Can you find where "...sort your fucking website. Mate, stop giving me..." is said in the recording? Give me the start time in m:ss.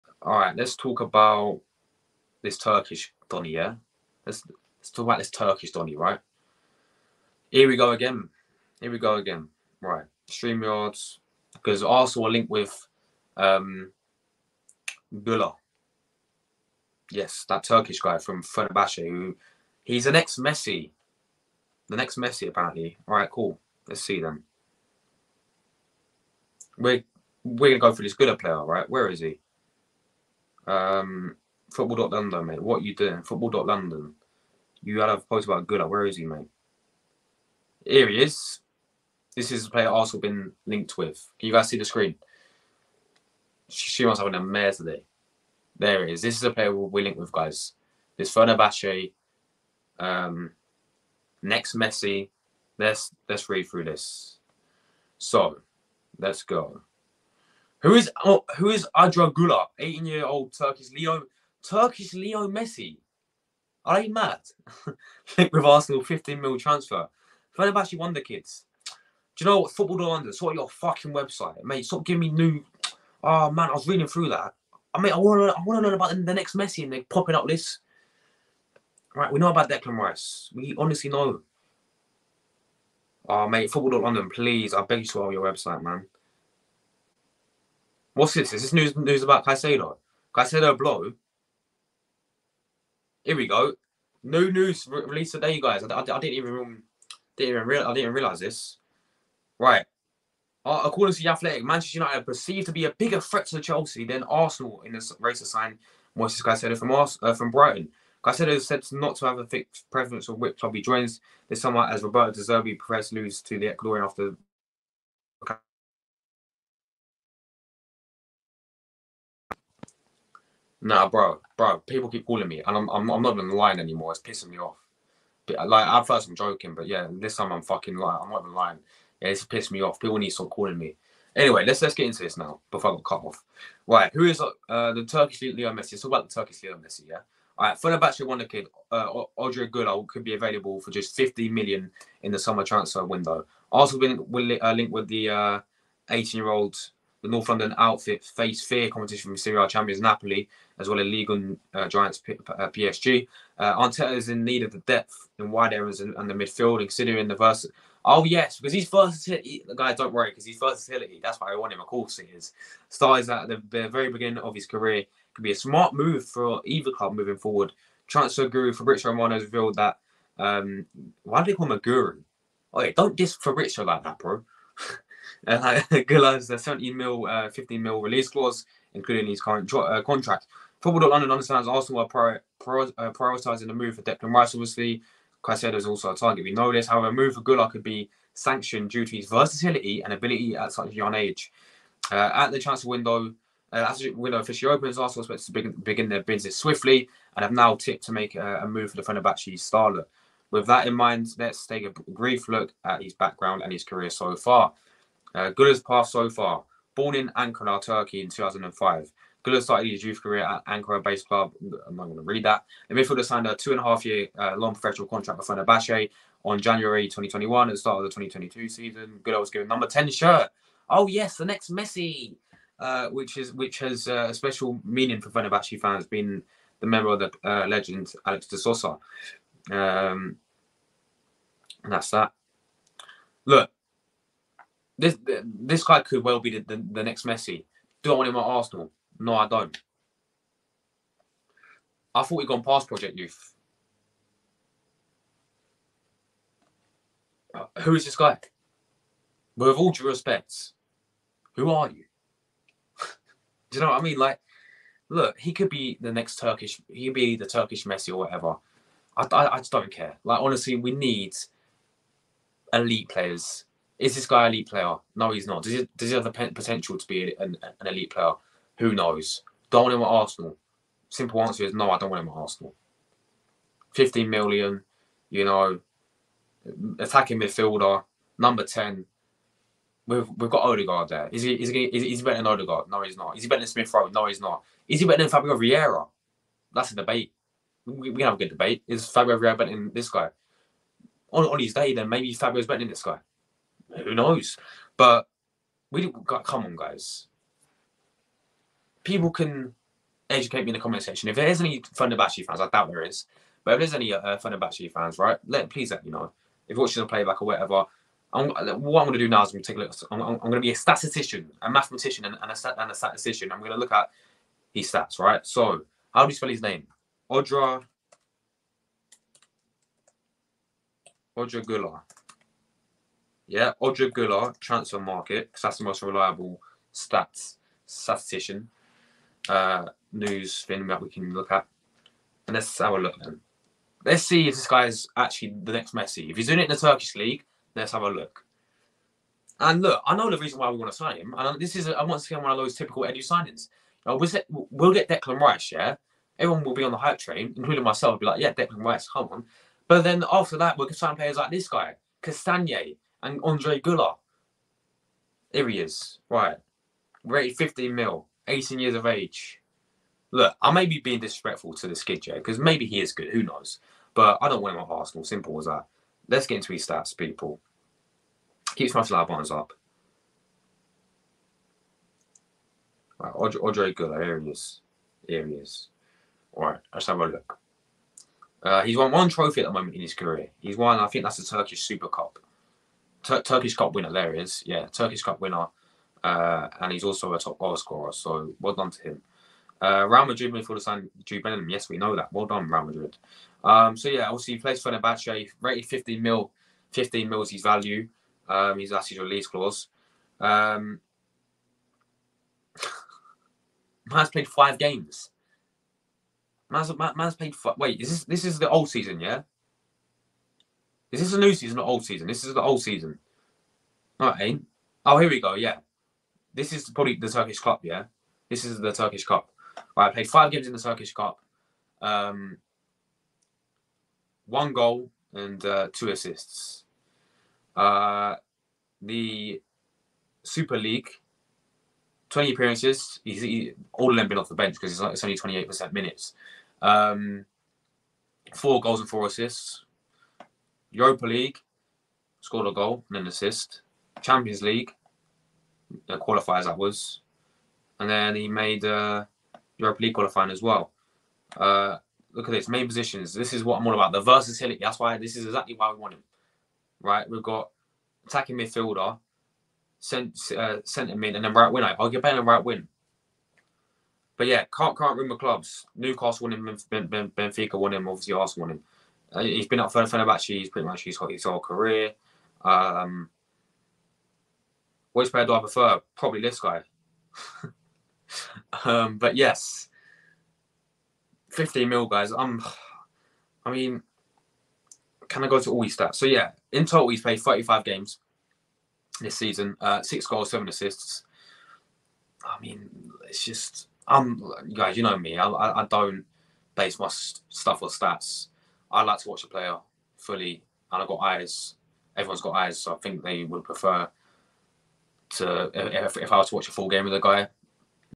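1:10.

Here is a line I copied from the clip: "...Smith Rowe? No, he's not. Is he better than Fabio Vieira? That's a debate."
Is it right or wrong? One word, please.
right.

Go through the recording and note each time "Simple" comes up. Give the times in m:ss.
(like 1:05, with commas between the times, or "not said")
4:31, 6:05.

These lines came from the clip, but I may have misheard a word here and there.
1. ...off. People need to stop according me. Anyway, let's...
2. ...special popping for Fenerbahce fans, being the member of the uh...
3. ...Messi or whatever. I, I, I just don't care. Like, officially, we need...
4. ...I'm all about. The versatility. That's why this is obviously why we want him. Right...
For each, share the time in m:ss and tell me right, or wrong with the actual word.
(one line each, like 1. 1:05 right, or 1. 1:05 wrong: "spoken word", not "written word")
1. 2:09 wrong: "calling", not "according"
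2. 3:44 wrong: "meaning", not "popping"
3. 4:17 wrong: "honestly", not "officially"
4. 7:33 wrong: "exactly", not "obviously".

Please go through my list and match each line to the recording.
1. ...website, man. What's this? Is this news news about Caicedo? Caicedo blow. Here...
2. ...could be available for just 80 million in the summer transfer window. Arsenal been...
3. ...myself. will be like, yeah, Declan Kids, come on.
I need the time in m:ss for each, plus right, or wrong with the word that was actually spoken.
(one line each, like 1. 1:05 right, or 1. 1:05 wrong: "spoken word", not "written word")
1. 1:25 right
2. 2:20 wrong: "50", not "80"
3. 5:47 wrong: "Rice", not "Kids".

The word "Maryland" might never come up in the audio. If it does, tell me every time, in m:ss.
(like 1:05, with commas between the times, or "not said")
not said.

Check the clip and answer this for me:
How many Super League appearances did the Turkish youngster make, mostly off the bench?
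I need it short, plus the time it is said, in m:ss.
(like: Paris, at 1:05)
20, at 7:12.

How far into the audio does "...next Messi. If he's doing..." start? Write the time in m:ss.
5:35.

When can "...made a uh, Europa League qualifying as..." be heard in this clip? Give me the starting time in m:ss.
7:28.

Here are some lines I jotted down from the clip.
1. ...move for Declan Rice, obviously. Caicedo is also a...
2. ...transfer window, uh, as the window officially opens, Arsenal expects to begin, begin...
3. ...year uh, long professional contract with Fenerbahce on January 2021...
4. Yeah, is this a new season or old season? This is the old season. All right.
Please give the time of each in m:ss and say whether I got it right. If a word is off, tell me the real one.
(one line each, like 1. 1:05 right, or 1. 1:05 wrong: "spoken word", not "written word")
1. 3:03 right
2. 3:12 right
3. 3:34 right
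4. 6:49 right.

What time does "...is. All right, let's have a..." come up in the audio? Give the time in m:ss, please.
6:15.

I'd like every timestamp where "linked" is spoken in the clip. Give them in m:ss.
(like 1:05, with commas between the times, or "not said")
0:12, 0:40, 0:47, 1:05.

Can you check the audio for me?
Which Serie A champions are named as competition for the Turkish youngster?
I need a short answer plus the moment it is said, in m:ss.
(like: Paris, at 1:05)
Napoli, at 2:30.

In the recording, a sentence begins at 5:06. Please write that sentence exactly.
If you're watching the playback or whatever, I'm, uh, what I'm going to do now is I'm going to take a look.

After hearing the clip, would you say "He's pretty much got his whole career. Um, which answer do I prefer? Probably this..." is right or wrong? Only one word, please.
wrong.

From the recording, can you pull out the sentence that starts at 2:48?
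Transfer guru Fabrizio Romano has revealed that.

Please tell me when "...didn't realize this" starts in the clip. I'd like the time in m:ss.
1:37.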